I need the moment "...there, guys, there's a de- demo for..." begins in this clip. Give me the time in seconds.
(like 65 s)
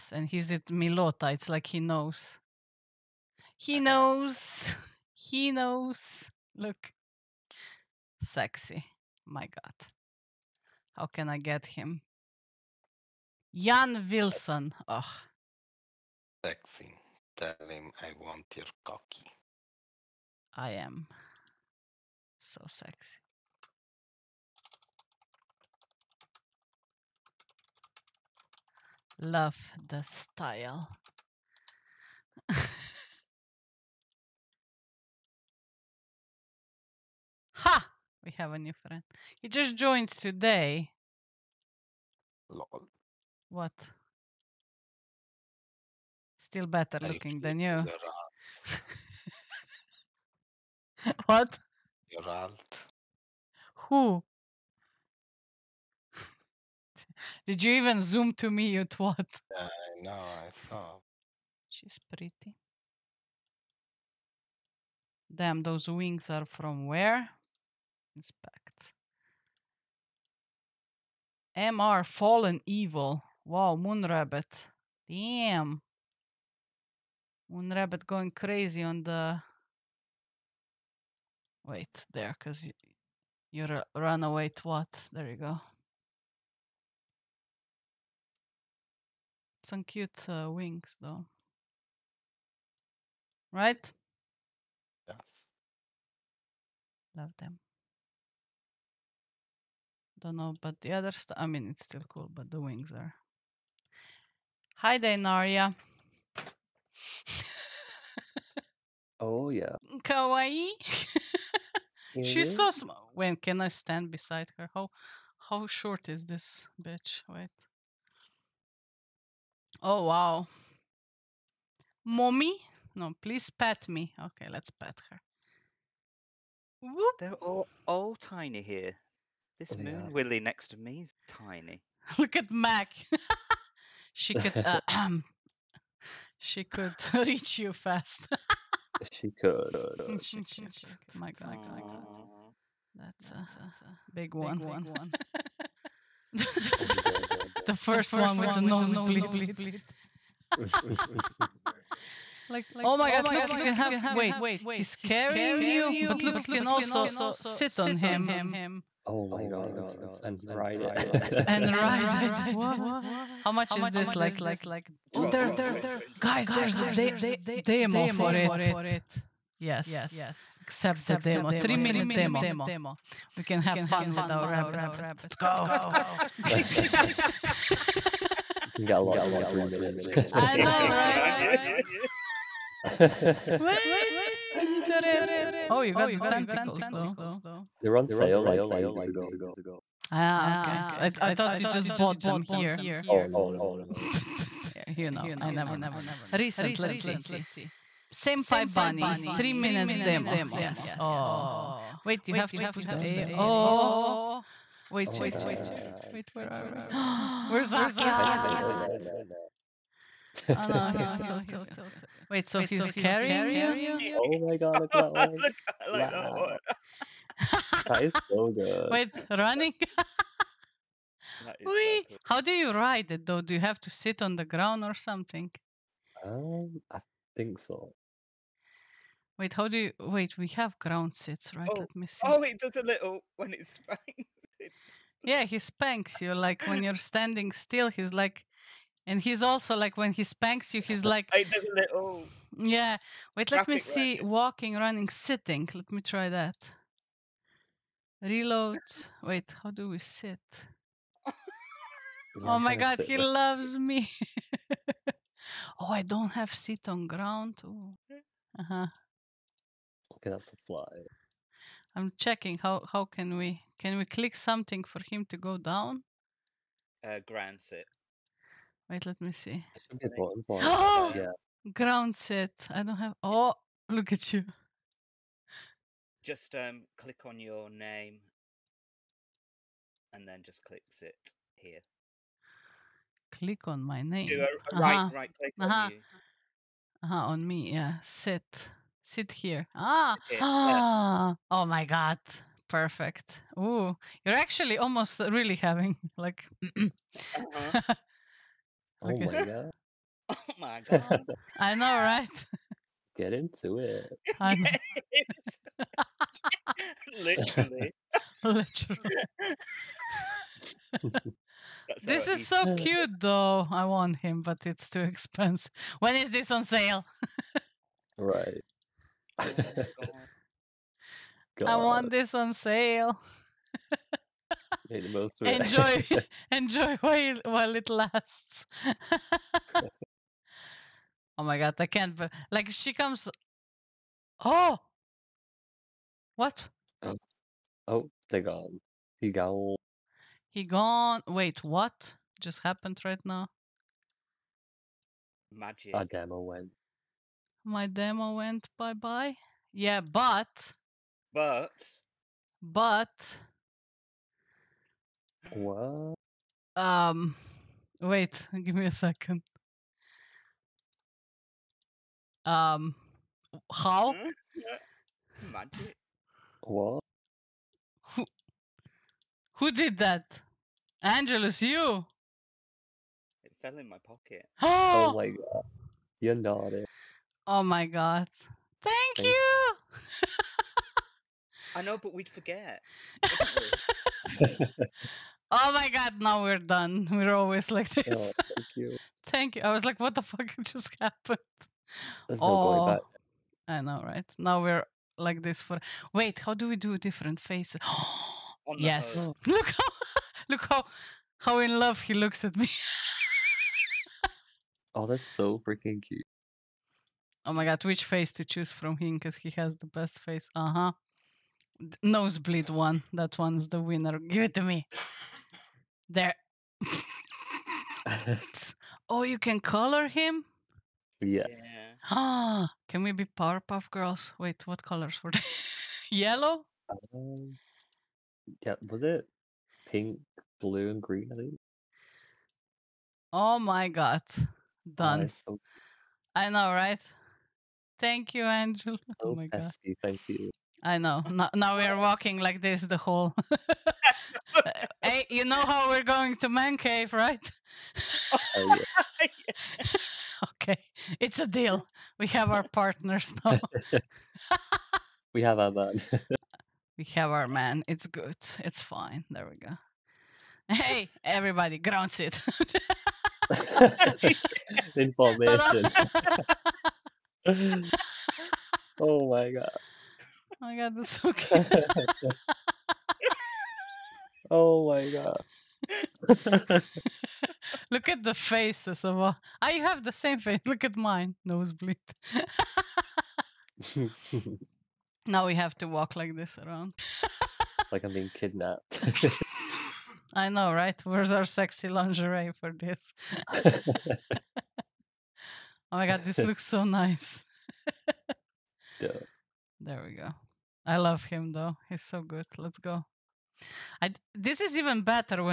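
165 s.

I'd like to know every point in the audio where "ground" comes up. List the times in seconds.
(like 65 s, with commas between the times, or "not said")
224 s, 230 s, 257 s, 267 s, 271 s, 461 s.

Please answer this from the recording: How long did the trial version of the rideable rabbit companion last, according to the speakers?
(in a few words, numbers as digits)
3 minutes.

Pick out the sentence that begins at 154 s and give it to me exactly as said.
Wait, he's carrying you, but look, you can also sit on him.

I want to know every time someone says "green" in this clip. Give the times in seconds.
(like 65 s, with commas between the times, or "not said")
431 s.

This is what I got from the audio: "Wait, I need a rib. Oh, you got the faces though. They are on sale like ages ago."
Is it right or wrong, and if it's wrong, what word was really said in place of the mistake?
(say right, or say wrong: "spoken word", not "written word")
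wrong: "tentacles", not "faces".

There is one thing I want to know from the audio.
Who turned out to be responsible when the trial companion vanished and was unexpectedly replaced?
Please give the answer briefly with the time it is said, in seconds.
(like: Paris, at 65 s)
Angelus, at 371 s.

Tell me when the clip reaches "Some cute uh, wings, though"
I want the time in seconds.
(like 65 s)
89 s.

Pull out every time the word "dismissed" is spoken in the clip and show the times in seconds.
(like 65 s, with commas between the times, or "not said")
not said.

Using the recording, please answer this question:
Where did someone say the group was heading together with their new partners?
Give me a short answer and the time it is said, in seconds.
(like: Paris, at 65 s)
Man cave, at 446 s.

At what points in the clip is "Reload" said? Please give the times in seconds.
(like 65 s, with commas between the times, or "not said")
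248 s.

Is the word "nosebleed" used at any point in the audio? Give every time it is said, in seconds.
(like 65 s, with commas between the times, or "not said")
148 s, 412 s, 481 s.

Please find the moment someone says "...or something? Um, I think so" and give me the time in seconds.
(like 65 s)
224 s.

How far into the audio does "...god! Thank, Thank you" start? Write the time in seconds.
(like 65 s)
377 s.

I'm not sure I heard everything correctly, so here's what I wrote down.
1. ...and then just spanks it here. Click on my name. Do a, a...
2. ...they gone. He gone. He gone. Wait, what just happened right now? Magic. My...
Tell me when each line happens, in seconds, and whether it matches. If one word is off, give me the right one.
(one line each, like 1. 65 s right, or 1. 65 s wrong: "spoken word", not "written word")
1. 280 s wrong: "clicks", not "spanks"
2. 338 s right.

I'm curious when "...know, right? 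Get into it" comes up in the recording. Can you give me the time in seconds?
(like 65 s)
301 s.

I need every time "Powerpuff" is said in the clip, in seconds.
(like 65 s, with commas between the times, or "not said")
423 s.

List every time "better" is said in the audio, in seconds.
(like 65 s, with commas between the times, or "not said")
46 s, 505 s.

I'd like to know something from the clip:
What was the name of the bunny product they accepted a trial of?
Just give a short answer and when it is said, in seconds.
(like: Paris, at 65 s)
Senpai Bunny, at 198 s.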